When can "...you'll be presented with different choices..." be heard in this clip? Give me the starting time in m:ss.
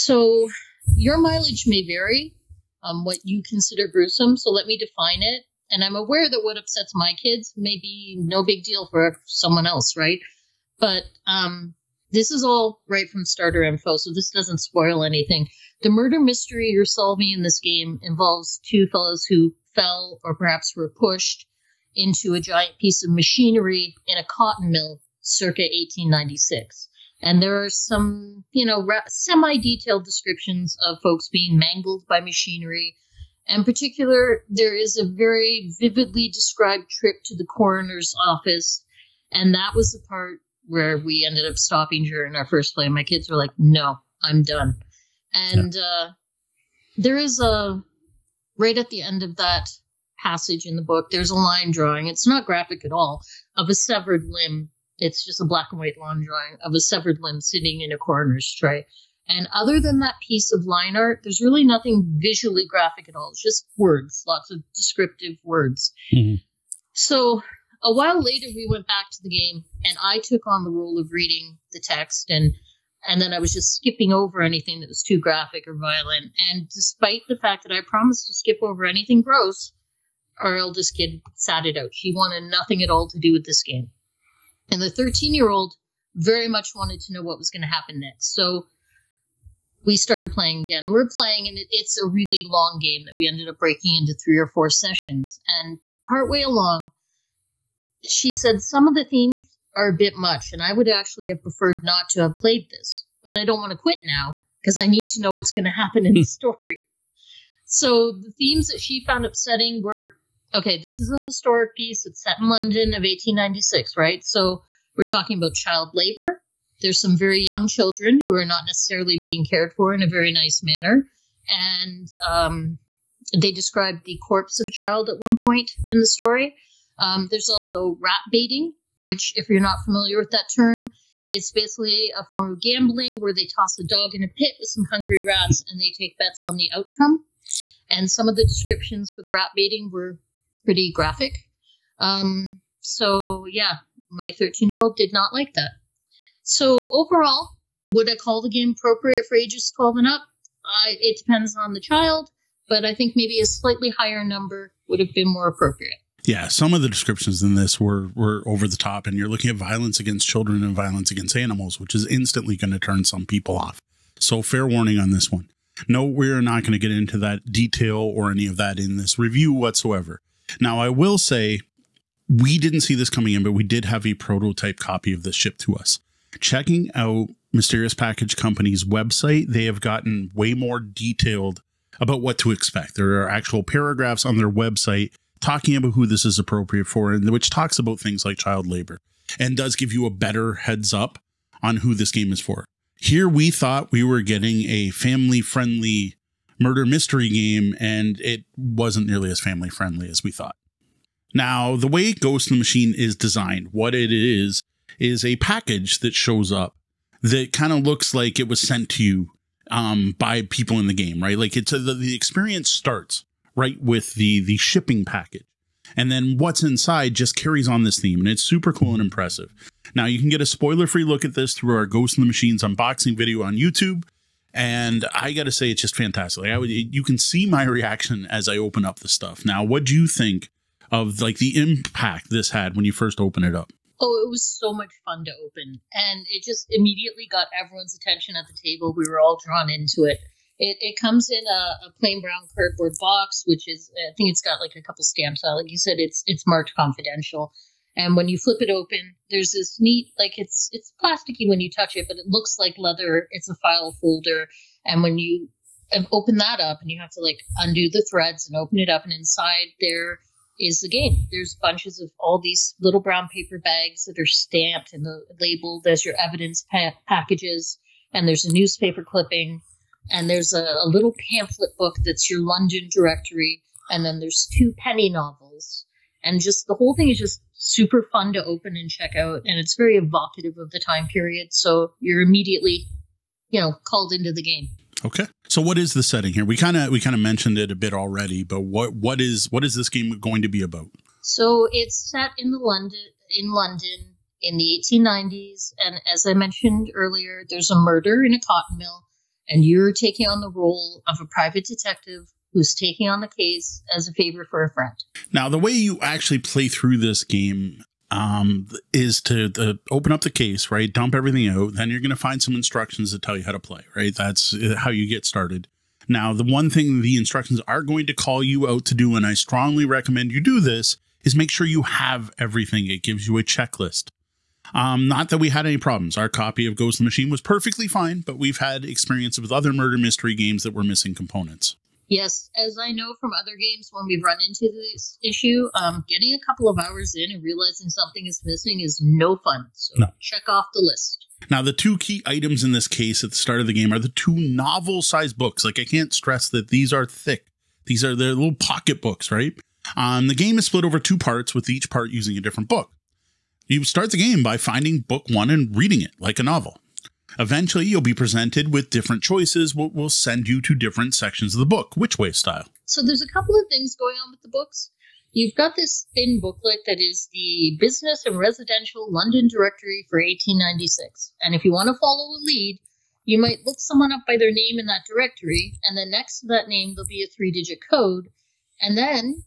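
5:57.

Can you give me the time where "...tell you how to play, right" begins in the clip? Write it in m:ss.
5:13.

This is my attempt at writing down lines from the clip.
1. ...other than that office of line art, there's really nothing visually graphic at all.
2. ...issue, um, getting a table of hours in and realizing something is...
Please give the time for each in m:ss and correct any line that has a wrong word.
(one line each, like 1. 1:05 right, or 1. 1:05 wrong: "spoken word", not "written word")
1. 0:59 wrong: "piece", not "office"
2. 5:35 wrong: "couple", not "table".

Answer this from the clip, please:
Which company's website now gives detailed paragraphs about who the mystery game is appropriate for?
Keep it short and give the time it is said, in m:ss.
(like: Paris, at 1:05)
Mysterious Package Company, at 2:57.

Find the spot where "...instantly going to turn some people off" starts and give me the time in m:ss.
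2:42.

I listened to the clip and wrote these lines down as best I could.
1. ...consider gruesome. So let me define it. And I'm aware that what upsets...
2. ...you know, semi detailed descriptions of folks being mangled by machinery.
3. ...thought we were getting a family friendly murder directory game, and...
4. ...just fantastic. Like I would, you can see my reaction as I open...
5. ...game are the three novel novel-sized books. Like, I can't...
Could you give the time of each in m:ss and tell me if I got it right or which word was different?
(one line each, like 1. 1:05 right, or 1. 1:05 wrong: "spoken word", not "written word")
1. 0:03 right
2. 0:28 right
3. 3:13 wrong: "mystery", not "directory"
4. 3:45 right
5. 5:43 wrong: "two", not "three".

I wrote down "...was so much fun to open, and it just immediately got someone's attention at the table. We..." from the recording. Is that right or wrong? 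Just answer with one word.
wrong.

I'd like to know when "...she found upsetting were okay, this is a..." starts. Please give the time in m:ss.
1:48.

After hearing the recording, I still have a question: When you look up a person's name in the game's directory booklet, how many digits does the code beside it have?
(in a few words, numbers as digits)
3.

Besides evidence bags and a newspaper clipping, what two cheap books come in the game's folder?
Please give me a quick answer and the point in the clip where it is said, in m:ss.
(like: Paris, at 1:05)
penny novels, at 4:34.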